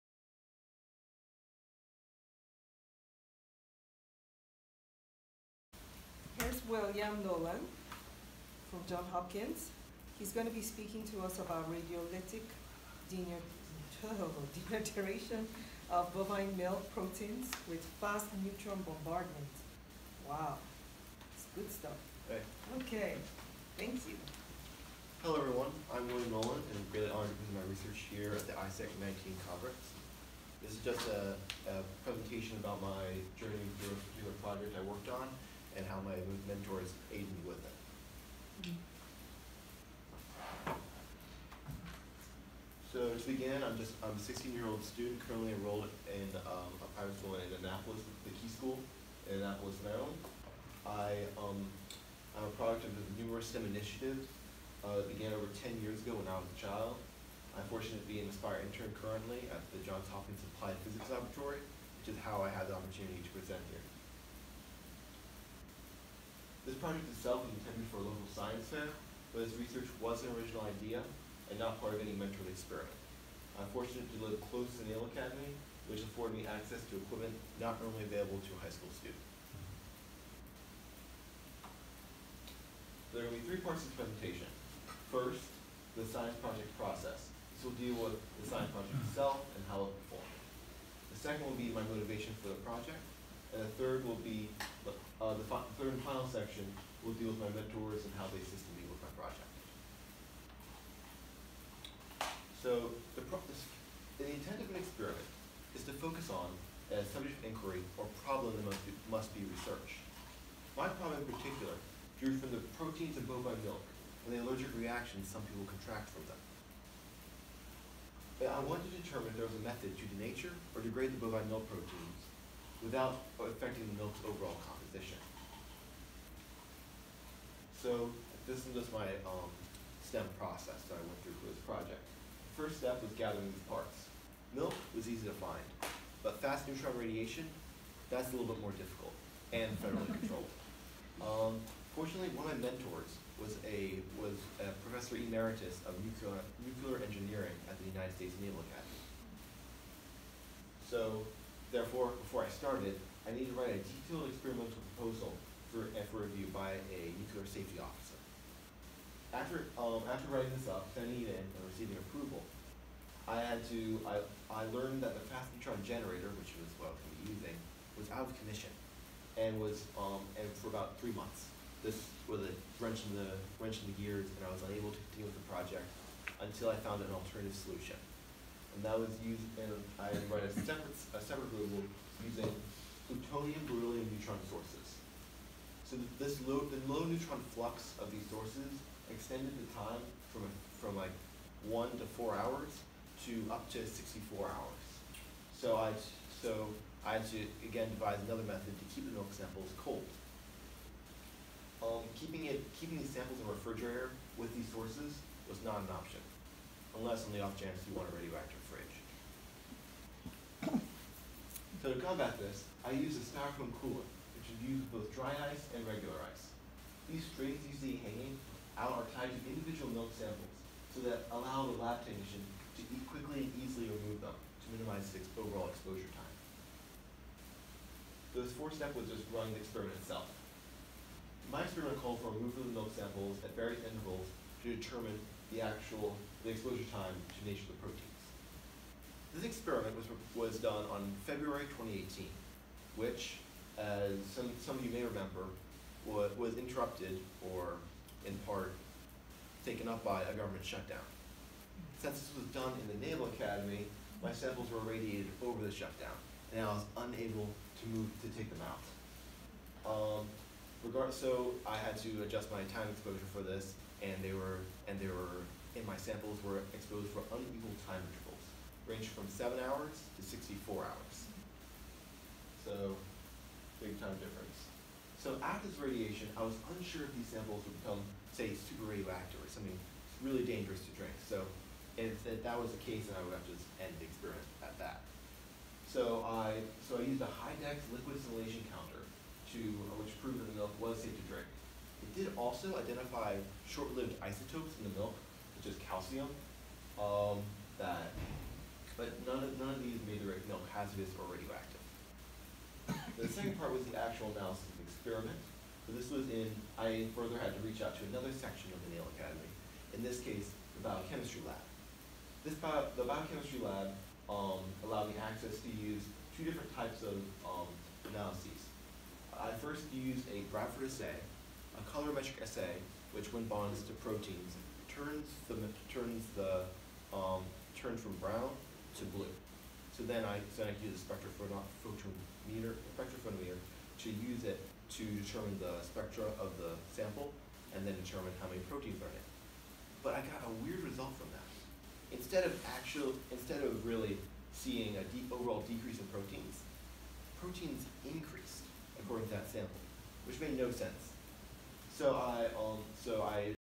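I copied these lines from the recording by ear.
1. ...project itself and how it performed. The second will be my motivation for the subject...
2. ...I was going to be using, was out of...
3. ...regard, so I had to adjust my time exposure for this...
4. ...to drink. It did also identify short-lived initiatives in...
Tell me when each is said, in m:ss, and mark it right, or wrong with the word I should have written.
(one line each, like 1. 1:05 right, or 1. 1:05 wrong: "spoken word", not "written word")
1. 1:28 wrong: "project", not "subject"
2. 2:46 right
3. 4:20 right
4. 4:51 wrong: "isotopes", not "initiatives".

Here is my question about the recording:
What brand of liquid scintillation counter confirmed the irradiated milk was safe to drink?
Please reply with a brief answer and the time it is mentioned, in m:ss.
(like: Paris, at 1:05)
Hidex, at 4:47.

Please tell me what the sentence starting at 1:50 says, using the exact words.
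My problem in particular drew from the proteins in bovine milk and the allergic reactions some people contract from them.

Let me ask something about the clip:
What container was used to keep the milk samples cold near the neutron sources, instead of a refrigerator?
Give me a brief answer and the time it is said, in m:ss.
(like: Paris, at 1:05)
Styrofoam cooler, at 3:33.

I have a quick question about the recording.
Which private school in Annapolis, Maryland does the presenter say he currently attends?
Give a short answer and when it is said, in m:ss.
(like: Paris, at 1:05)
The Key School, at 0:48.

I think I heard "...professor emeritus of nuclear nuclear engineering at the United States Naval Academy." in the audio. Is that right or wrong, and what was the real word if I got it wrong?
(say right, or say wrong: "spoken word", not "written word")
right.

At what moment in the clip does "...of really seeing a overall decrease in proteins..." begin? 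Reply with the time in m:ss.
5:43.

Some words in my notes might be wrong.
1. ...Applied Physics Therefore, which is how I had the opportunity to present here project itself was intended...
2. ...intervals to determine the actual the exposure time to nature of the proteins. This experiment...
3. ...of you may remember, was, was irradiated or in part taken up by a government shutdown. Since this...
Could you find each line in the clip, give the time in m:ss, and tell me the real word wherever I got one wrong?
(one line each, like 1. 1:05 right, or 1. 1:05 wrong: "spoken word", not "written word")
1. 1:00 wrong: "Laboratory", not "Therefore"
2. 3:53 right
3. 4:04 wrong: "interrupted", not "irradiated".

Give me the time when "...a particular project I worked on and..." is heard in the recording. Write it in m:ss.
0:33.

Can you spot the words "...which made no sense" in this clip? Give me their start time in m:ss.
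5:50.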